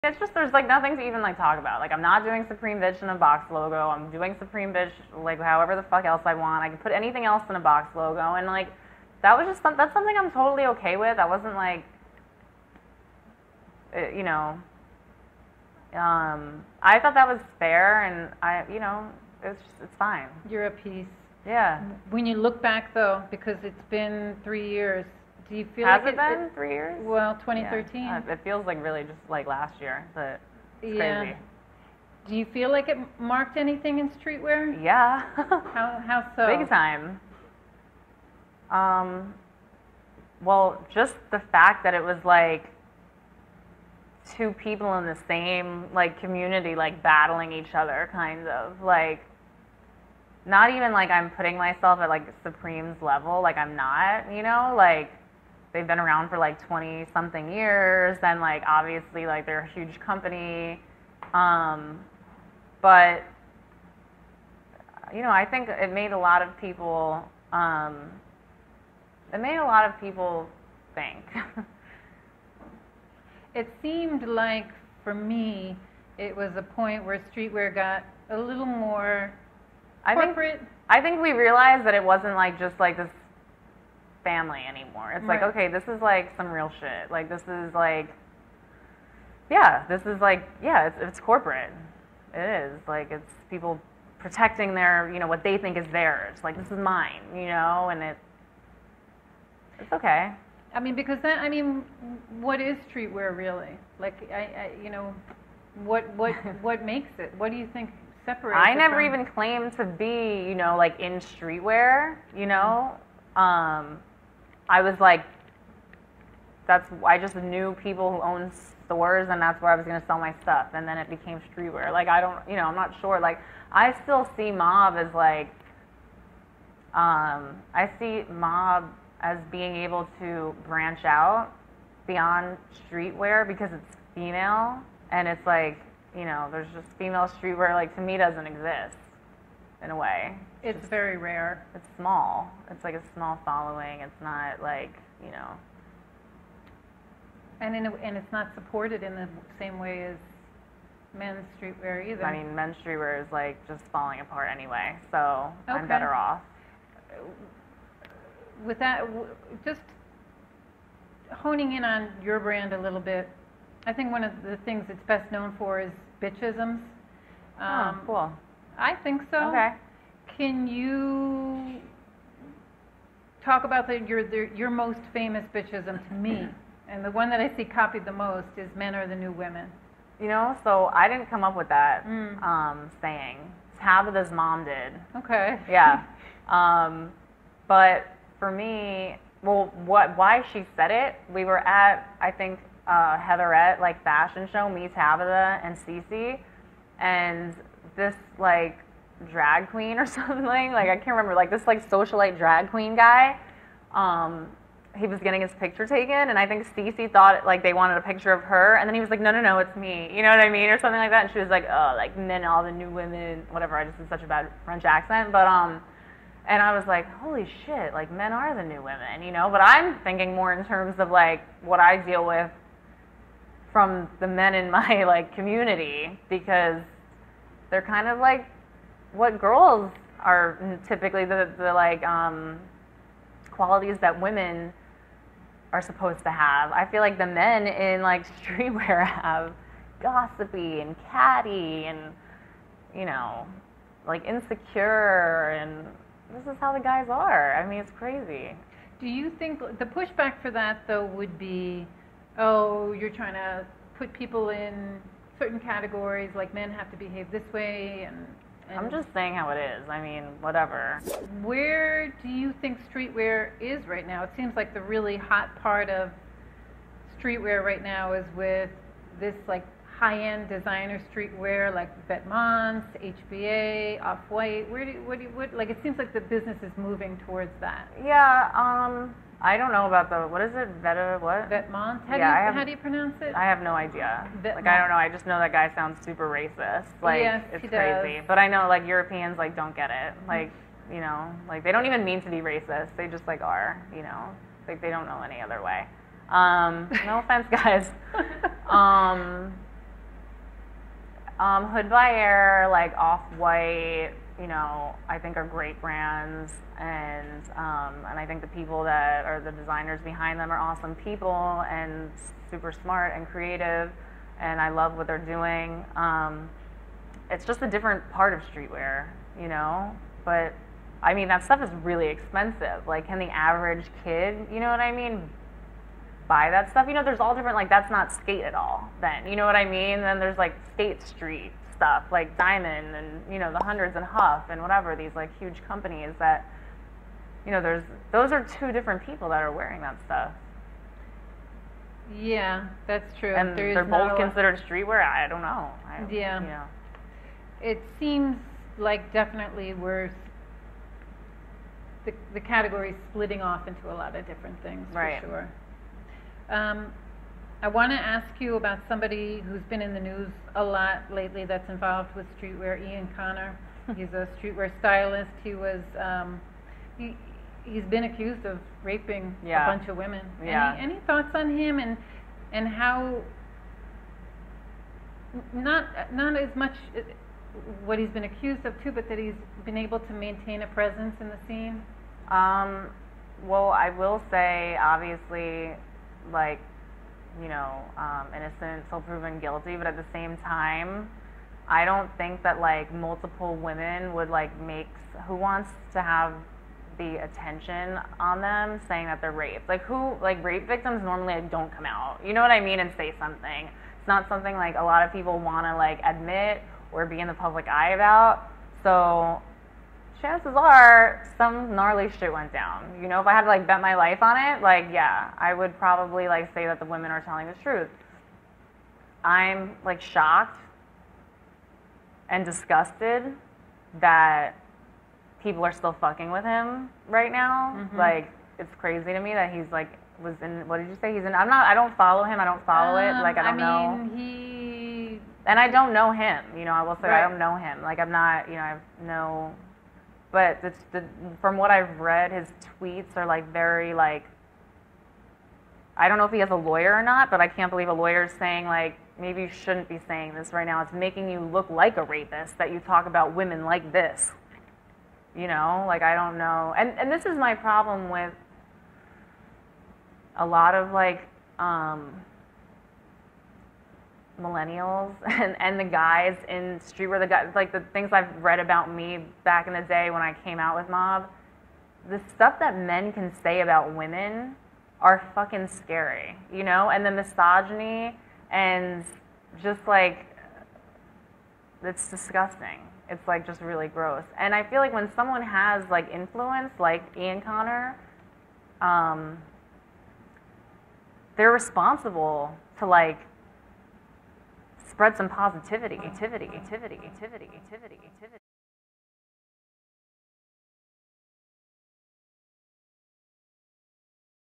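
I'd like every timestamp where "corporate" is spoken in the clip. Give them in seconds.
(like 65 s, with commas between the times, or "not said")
80 s, 91 s.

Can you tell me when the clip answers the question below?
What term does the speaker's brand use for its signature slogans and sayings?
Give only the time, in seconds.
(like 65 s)
166 s.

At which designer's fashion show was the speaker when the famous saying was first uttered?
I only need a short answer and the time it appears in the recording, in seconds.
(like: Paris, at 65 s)
Heatherette, at 193 s.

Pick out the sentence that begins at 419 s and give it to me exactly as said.
I'm like shocked and disgusted that people are still fucking with him right now.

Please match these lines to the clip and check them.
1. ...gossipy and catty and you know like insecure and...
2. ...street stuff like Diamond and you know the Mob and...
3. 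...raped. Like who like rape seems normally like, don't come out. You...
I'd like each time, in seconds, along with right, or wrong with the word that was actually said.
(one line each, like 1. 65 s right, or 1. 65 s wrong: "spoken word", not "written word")
1. 240 s right
2. 331 s wrong: "Hundreds", not "Mob"
3. 399 s wrong: "victims", not "seems".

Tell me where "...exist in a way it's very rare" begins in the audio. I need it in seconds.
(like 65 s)
138 s.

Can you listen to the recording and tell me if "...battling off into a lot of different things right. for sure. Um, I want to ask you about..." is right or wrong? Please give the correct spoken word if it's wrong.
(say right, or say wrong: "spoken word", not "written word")
wrong: "splitting", not "battling".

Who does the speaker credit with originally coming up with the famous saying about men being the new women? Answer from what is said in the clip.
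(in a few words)
Tabitha's mom.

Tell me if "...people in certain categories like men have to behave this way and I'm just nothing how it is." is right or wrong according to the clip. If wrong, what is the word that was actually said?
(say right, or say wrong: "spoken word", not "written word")
wrong: "saying", not "nothing".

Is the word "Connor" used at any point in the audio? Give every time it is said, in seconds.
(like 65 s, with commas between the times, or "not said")
363 s, 487 s.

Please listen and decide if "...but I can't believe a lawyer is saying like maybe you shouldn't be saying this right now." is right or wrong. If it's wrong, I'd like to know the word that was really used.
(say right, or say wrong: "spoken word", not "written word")
right.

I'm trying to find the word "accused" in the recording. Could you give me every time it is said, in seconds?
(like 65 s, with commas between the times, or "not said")
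368 s, 378 s.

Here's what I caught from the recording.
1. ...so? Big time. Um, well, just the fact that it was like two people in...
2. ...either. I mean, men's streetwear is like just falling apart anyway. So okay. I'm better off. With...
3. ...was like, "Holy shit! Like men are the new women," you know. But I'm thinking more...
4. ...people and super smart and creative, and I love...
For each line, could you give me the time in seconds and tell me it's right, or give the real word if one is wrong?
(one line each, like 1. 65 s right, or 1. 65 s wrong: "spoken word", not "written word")
1. 36 s right
2. 152 s right
3. 216 s right
4. 310 s right.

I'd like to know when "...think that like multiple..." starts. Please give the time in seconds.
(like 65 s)
392 s.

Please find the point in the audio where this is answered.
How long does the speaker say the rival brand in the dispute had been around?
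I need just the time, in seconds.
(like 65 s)
56 s.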